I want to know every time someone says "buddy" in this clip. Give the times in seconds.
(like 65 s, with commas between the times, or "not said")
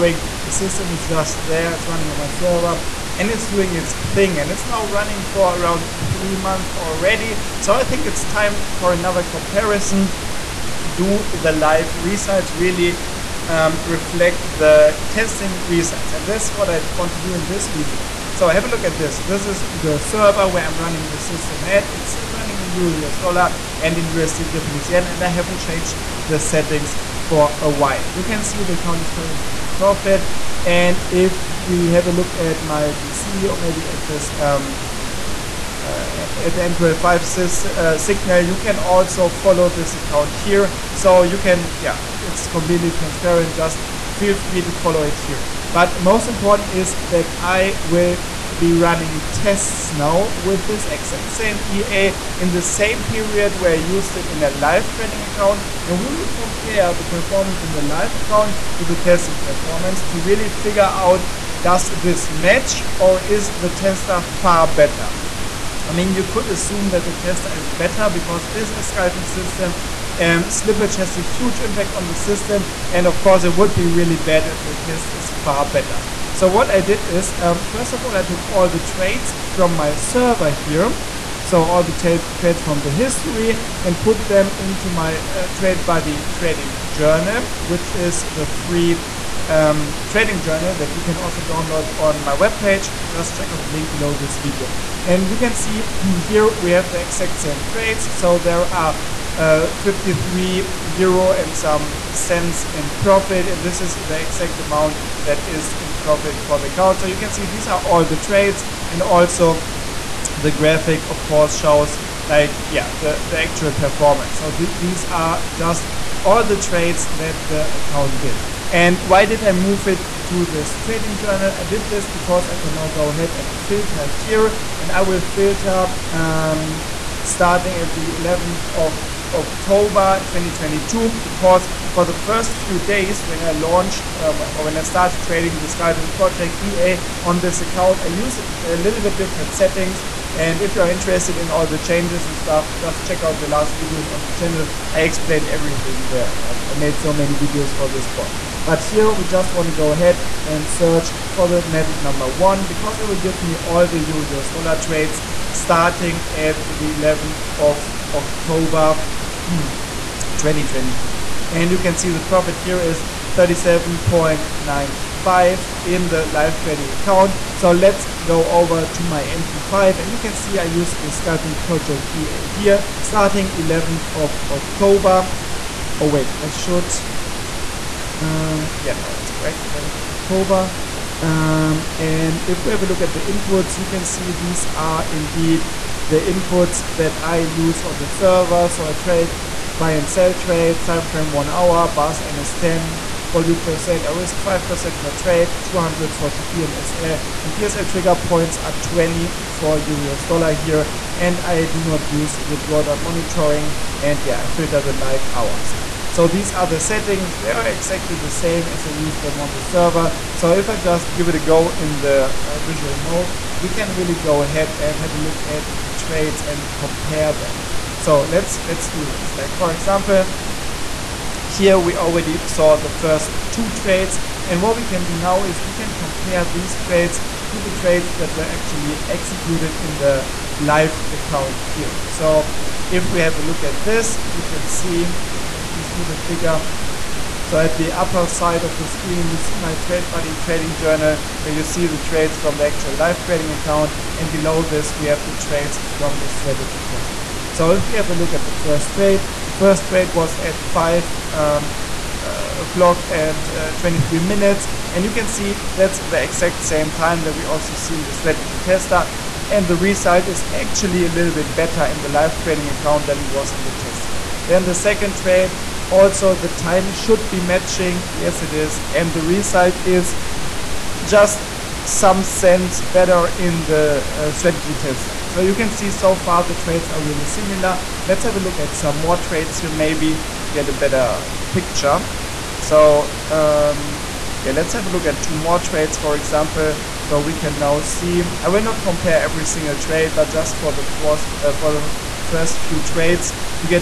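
85 s, 240 s.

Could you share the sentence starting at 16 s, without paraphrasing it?
And that's what I want to do in this video.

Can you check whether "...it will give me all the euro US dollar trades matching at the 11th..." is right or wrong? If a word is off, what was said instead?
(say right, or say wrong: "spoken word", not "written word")
wrong: "starting", not "matching".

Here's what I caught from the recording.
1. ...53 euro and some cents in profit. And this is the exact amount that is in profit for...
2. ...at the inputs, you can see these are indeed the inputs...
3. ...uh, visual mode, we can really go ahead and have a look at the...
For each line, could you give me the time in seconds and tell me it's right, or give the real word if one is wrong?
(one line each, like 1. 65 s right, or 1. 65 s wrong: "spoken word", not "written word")
1. 99 s right
2. 182 s right
3. 212 s right.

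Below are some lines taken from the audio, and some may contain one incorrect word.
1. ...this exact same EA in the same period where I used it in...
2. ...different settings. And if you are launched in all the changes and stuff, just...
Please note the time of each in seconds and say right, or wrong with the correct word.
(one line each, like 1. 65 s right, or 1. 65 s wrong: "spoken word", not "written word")
1. 50 s right
2. 139 s wrong: "interested", not "launched".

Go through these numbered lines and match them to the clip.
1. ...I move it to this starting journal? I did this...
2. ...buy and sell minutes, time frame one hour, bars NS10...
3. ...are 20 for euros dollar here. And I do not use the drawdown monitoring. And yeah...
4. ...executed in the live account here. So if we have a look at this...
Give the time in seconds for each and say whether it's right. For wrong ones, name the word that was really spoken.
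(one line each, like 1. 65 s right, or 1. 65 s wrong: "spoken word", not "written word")
1. 119 s wrong: "trading", not "starting"
2. 189 s wrong: "trades", not "minutes"
3. 198 s right
4. 229 s right.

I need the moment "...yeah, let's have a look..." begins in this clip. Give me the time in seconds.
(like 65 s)
284 s.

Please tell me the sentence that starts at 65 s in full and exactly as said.
I mean, you could assume that the tester is better because it is a scalping system.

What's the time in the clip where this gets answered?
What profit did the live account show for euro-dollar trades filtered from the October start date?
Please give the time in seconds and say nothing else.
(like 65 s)
163 s.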